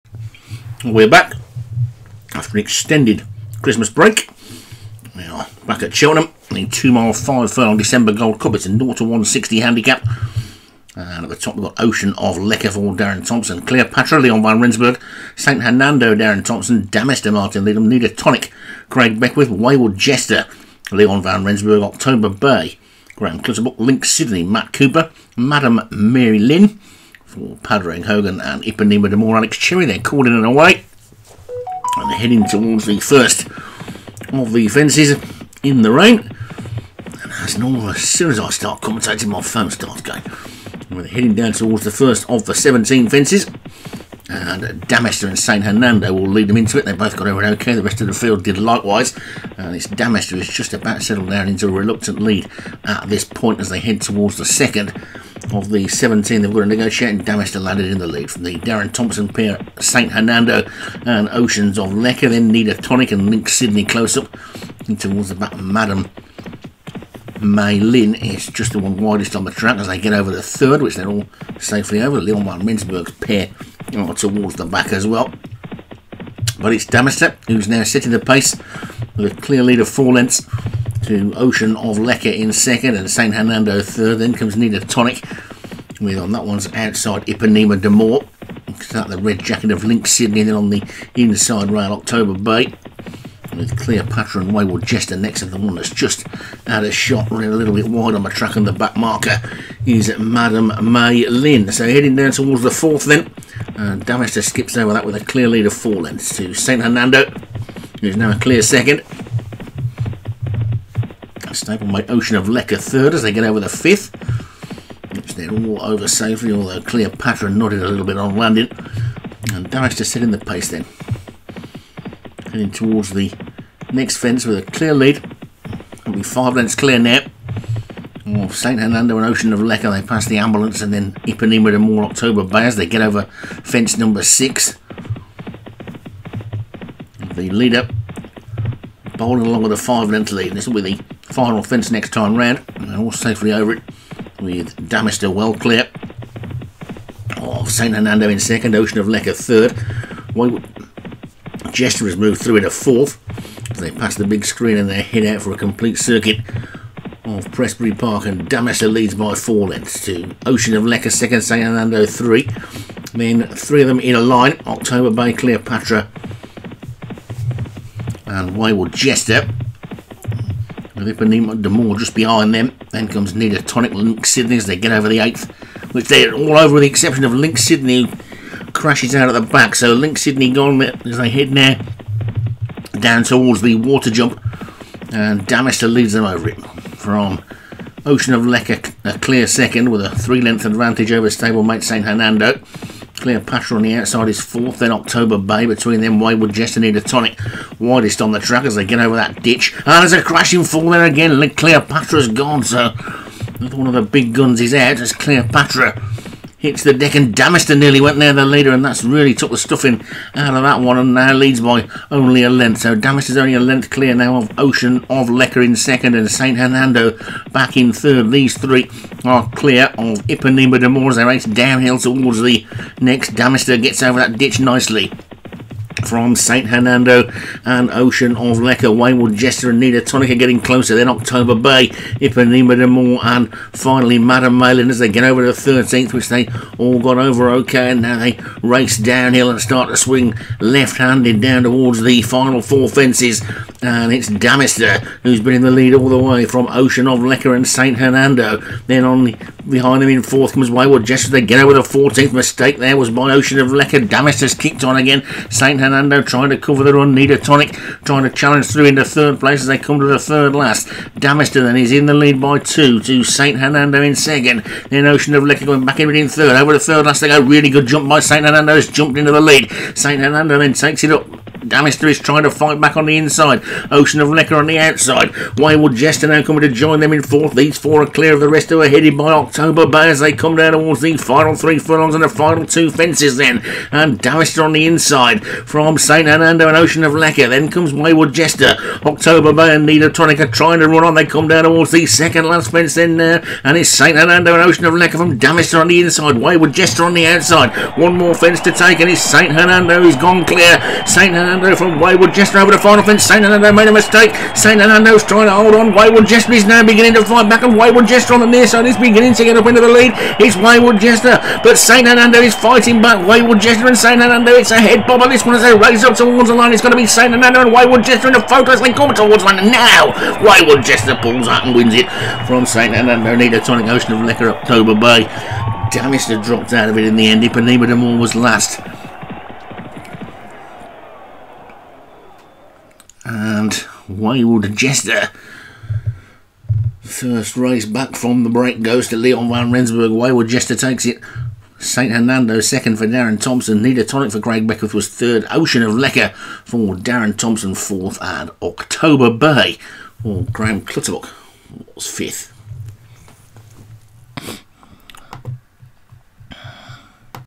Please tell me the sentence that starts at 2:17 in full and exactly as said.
The leader bowling along with a five length lead.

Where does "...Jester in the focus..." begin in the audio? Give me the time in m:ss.
5:18.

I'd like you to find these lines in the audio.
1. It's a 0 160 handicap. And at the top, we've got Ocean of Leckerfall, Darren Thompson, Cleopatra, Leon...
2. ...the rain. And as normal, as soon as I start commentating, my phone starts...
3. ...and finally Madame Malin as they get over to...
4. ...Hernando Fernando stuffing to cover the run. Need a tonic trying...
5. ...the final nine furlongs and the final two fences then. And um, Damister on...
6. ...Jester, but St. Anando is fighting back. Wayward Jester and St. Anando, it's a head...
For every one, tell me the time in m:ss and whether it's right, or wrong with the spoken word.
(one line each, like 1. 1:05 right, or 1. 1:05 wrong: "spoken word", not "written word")
1. 0:08 right
2. 0:35 right
3. 3:53 right
4. 4:15 wrong: "trying", not "stuffing"
5. 4:41 wrong: "three", not "nine"
6. 5:10 right.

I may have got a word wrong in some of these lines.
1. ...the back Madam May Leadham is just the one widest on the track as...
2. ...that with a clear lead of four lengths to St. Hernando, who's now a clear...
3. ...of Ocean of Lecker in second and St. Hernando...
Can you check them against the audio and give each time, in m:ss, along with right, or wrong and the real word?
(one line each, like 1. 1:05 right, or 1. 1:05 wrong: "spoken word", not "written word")
1. 1:05 wrong: "Lynn", not "Leadham"
2. 1:44 right
3. 3:34 right.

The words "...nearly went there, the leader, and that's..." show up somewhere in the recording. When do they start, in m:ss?
3:27.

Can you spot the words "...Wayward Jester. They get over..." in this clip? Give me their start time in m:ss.
4:10.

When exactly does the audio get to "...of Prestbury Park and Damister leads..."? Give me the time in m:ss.
2:37.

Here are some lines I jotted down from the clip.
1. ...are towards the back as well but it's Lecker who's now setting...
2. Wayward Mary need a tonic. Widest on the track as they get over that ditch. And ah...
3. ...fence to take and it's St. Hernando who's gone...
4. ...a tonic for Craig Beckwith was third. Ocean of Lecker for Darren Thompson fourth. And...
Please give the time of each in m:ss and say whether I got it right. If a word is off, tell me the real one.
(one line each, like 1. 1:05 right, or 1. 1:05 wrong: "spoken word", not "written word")
1. 1:13 wrong: "Damister", not "Lecker"
2. 3:16 wrong: "Jester", not "Mary"
3. 4:58 right
4. 5:43 right.